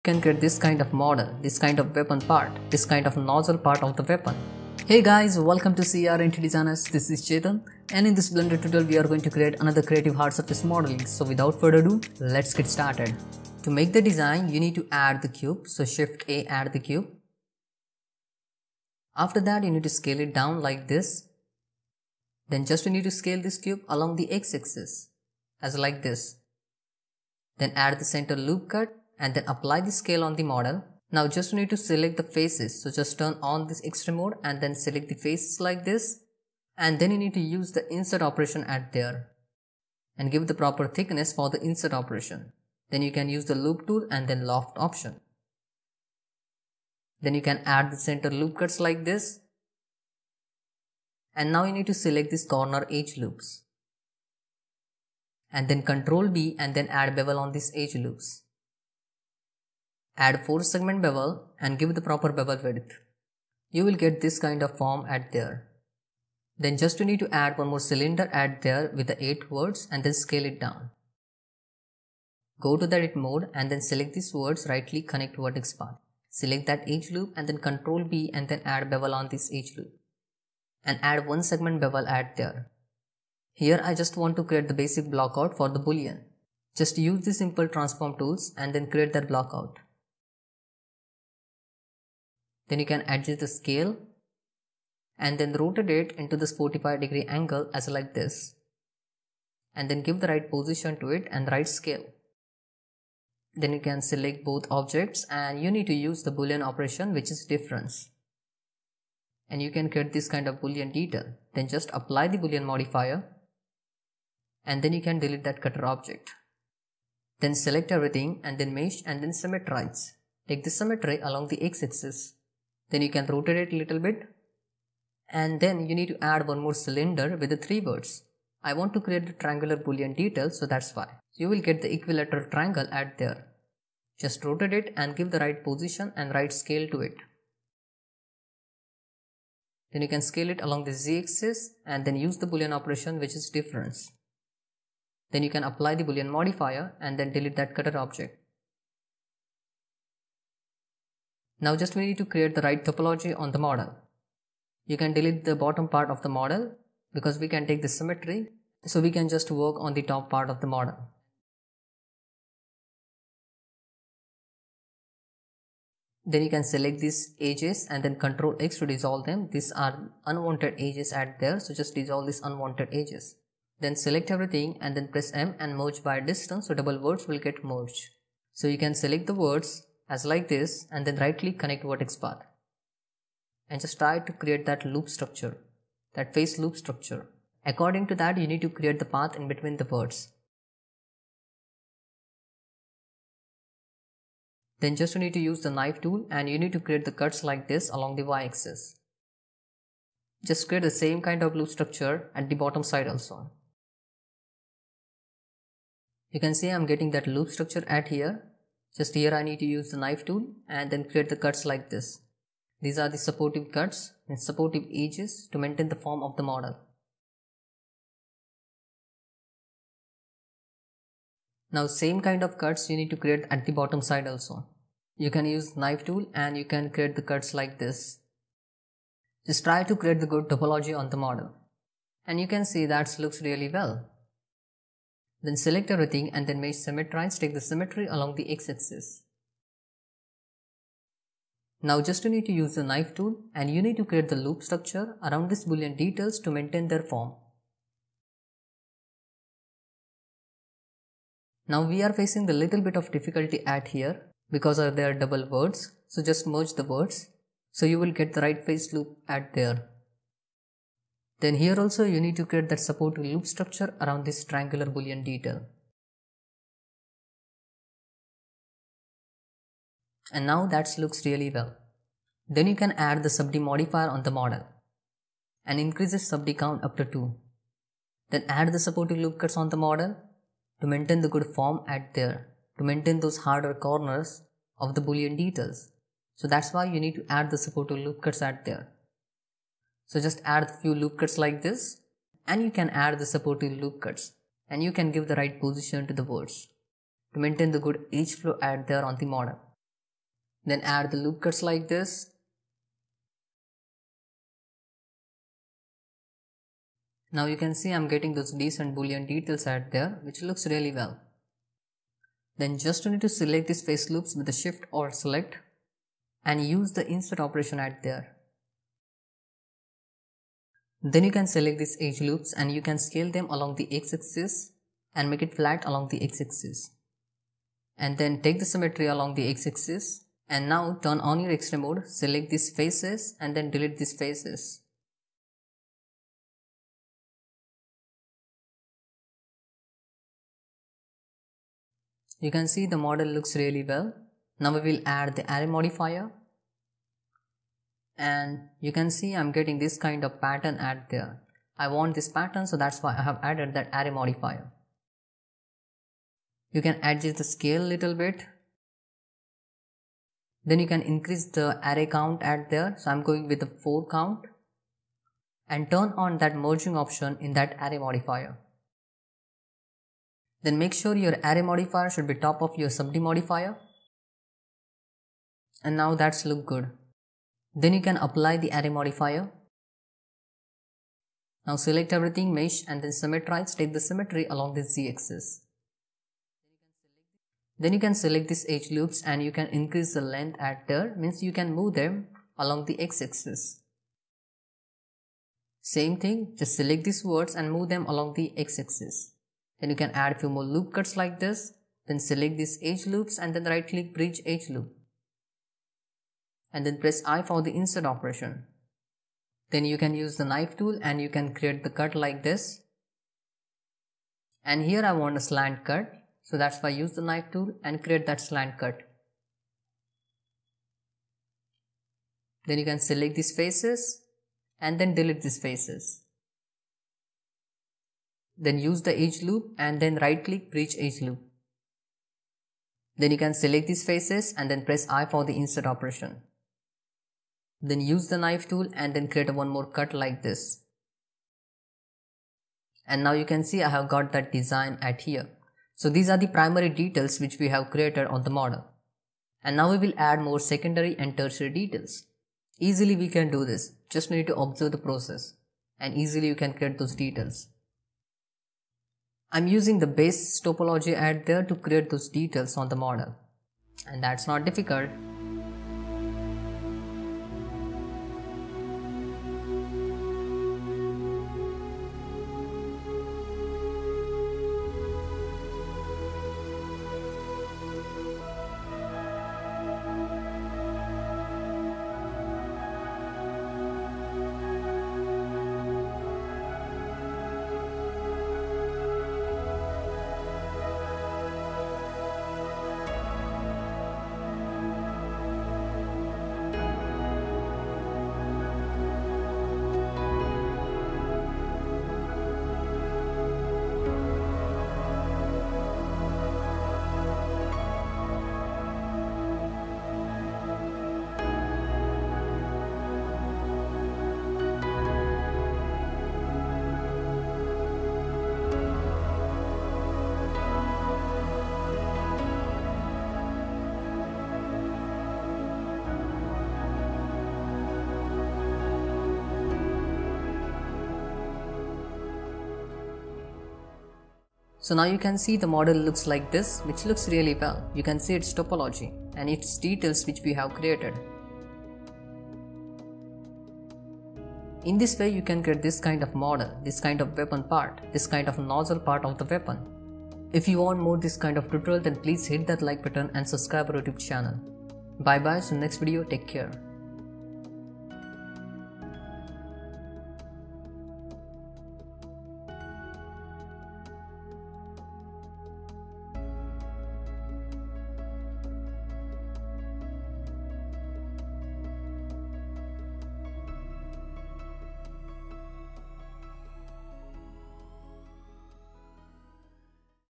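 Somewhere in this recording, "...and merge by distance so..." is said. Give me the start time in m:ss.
2:55.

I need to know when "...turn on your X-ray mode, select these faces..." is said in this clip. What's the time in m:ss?
5:31.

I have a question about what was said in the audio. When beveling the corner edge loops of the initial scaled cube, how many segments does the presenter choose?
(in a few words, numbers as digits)
4.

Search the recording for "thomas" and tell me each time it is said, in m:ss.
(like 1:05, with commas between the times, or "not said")
not said.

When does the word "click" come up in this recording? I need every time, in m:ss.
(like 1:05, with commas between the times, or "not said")
1:14, 3:01, 6:43, 7:10.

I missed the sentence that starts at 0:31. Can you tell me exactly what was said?
Now just need to select the faces.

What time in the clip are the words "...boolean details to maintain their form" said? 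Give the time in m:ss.
4:05.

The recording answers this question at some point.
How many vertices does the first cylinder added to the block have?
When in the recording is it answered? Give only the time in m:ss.
1:09.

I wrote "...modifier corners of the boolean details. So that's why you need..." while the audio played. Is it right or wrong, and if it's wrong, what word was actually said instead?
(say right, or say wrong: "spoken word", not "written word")
wrong: "harder", not "modifier".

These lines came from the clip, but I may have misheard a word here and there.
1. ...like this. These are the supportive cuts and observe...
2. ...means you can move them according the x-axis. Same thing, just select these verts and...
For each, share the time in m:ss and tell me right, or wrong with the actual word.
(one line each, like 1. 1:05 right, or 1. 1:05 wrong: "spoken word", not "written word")
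1. 3:31 wrong: "supportive", not "observe"
2. 6:31 wrong: "along", not "according".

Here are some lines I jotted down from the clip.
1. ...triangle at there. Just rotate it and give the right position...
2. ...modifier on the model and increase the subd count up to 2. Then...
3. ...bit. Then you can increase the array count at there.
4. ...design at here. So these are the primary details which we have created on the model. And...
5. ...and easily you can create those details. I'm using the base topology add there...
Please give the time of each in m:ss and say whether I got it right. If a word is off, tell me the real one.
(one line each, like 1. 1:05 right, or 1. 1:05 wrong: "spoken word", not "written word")
1. 2:12 right
2. 4:33 right
3. 5:58 right
4. 7:24 right
5. 7:35 right.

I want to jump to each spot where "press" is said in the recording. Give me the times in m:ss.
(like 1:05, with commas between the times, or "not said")
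2:55, 6:46, 7:14.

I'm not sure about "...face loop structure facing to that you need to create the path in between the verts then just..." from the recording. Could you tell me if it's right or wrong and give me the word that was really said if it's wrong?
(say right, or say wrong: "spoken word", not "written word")
wrong: "according", not "facing".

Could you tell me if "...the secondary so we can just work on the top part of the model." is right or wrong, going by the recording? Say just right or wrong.
wrong.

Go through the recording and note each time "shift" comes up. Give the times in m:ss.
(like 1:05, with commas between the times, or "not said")
0:15, 5:14.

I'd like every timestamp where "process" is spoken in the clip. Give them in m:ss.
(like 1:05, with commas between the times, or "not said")
7:34.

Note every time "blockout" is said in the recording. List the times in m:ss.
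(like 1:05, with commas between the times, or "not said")
1:25, 1:29.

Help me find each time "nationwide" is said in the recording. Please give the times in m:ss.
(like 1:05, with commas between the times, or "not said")
not said.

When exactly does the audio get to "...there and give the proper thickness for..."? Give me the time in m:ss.
0:38.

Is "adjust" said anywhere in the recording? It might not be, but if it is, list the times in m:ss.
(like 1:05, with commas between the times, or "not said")
1:33, 5:57.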